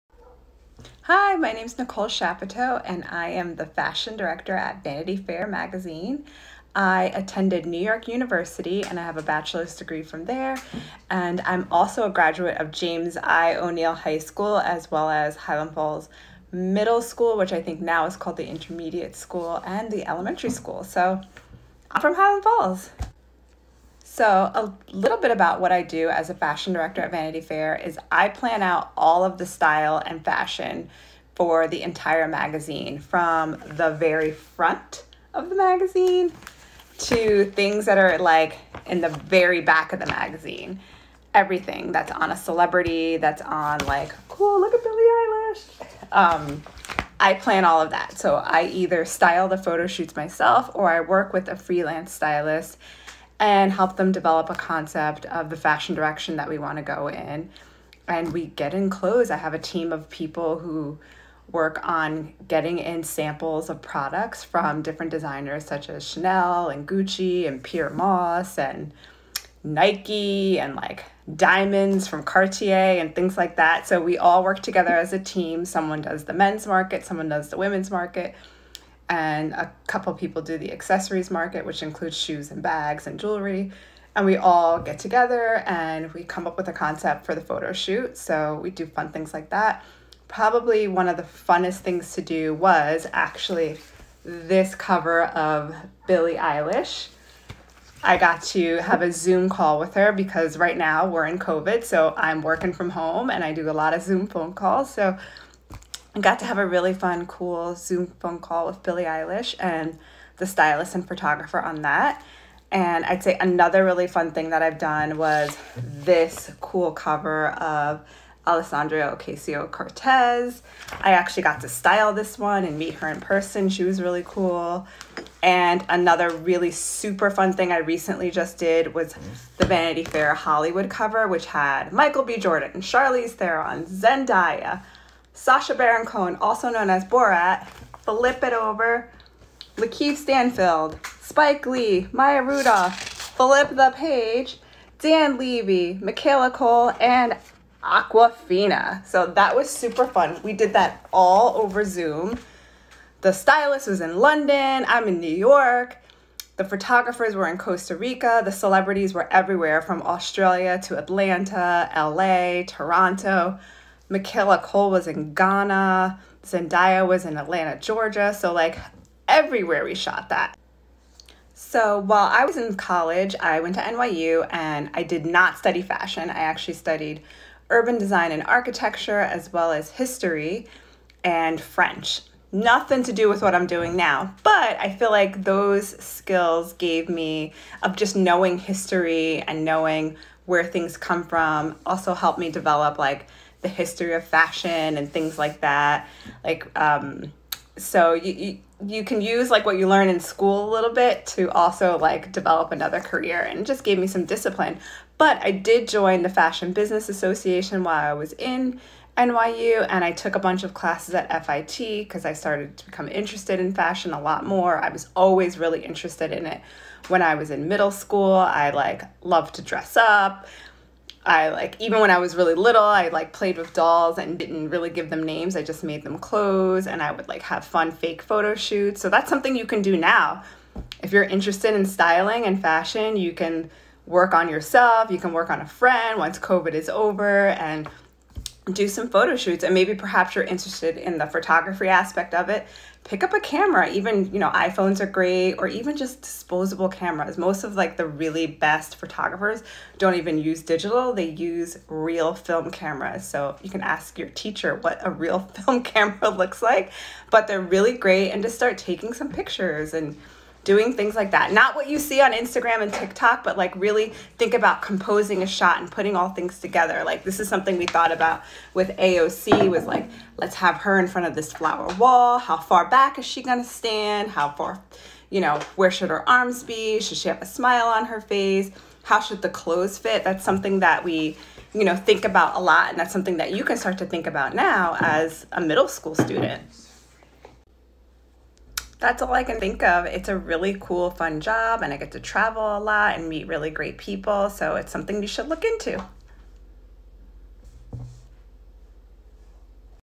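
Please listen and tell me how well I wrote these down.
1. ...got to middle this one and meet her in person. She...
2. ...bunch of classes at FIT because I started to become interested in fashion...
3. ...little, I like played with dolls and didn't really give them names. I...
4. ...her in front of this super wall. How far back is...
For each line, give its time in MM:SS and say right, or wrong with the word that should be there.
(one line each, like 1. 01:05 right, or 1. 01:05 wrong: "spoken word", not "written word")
1. 02:01 wrong: "style", not "middle"
2. 03:30 right
3. 03:42 right
4. 04:30 wrong: "flower", not "super".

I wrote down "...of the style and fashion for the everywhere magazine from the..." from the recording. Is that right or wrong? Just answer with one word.
wrong.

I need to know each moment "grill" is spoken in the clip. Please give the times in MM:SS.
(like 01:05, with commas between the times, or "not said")
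not said.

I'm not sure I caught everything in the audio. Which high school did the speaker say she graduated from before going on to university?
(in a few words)
James I. O'Neill High School.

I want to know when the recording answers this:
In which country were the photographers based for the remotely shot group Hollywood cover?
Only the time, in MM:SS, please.
02:37.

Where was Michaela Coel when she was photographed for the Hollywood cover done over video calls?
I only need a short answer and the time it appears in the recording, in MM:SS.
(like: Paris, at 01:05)
Ghana, at 02:45.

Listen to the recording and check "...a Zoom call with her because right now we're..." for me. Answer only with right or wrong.
right.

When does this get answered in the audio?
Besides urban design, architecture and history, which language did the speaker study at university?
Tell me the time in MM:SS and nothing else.
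03:01.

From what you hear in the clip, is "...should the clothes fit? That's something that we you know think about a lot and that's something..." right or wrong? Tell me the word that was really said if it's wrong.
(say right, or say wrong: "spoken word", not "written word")
right.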